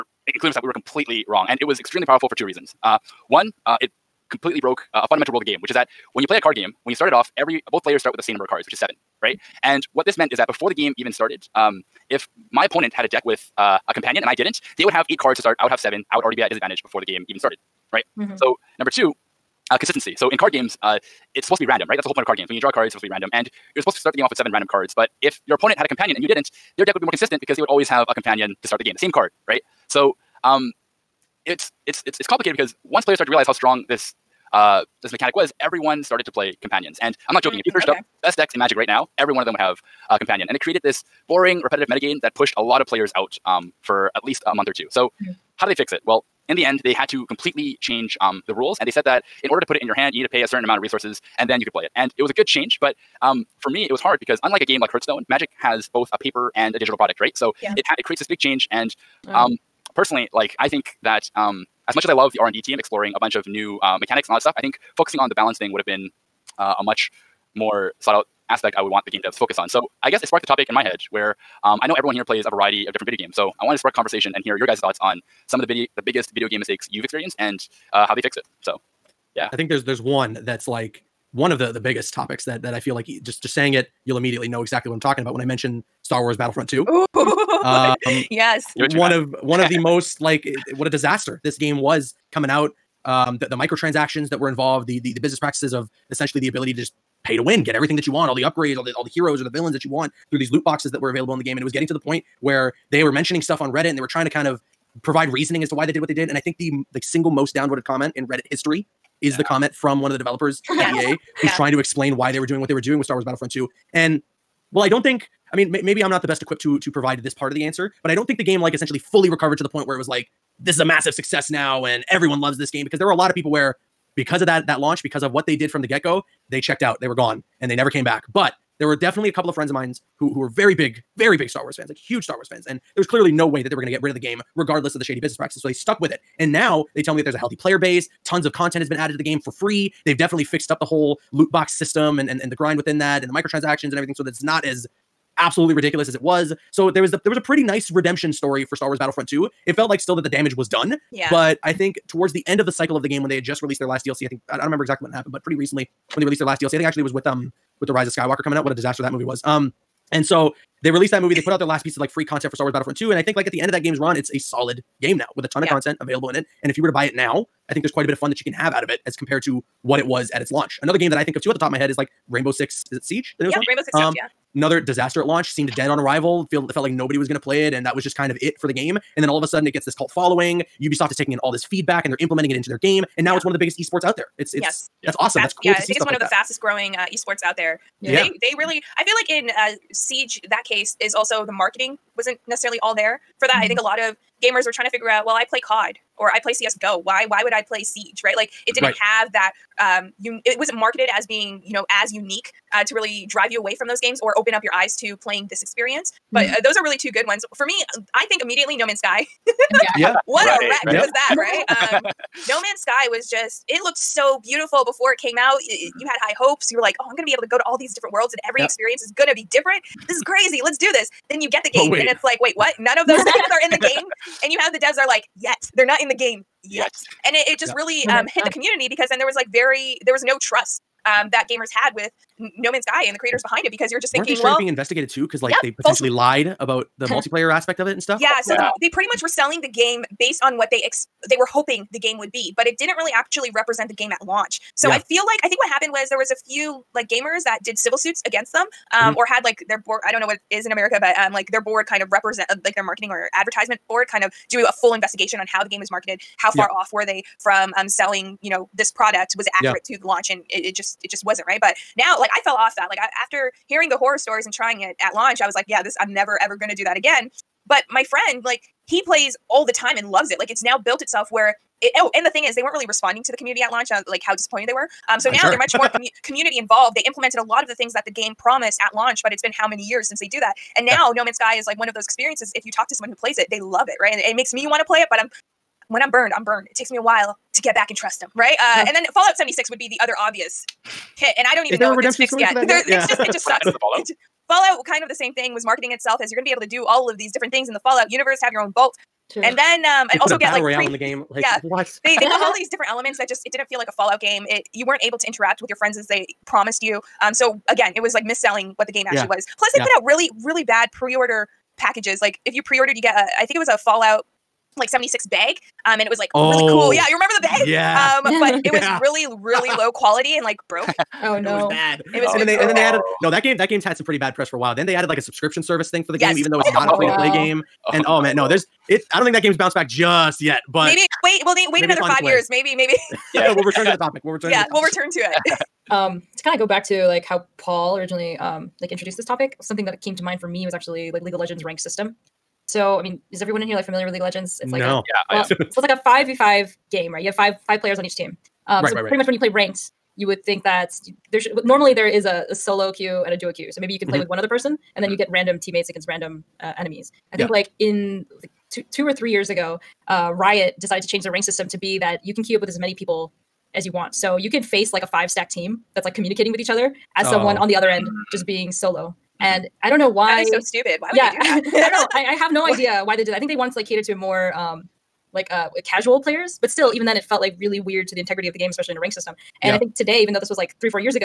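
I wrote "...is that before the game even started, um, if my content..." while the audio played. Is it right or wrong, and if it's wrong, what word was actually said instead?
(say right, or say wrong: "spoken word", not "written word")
wrong: "opponent", not "content".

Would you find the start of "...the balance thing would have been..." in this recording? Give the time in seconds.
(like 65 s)
65 s.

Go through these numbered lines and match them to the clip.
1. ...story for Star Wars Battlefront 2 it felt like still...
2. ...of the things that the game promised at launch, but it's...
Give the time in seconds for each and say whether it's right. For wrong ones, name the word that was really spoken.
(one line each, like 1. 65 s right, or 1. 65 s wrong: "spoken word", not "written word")
1. 148 s right
2. 277 s right.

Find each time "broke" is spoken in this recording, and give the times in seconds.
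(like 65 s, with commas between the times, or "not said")
4 s, 320 s.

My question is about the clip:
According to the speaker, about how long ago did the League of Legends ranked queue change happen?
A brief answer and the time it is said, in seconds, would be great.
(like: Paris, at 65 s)
2 or 3 years, at 358 s.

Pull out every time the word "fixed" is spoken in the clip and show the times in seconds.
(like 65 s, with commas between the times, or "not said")
78 s, 140 s.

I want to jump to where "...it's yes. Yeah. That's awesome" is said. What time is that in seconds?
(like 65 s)
184 s.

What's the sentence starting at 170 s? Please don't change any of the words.
Another game that I think of too at the top of my head is like Rainbow Six.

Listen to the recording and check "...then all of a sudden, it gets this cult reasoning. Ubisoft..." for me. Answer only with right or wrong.
wrong.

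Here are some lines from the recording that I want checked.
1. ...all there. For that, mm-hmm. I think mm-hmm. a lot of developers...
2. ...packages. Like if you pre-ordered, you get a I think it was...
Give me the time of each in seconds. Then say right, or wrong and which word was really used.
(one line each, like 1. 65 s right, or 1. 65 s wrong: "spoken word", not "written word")
1. 192 s wrong: "gamers", not "developers"
2. 311 s right.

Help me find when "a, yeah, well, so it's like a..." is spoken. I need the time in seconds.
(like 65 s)
345 s.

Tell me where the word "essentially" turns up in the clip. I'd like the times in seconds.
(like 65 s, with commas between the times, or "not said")
96 s, 118 s.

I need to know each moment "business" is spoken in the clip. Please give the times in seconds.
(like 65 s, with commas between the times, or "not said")
95 s, 135 s.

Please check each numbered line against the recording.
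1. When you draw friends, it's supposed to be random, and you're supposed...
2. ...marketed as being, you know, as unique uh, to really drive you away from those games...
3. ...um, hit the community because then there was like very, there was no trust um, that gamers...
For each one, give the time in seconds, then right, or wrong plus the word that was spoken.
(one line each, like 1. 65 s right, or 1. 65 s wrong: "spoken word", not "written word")
1. 22 s wrong: "cards", not "friends"
2. 200 s right
3. 228 s right.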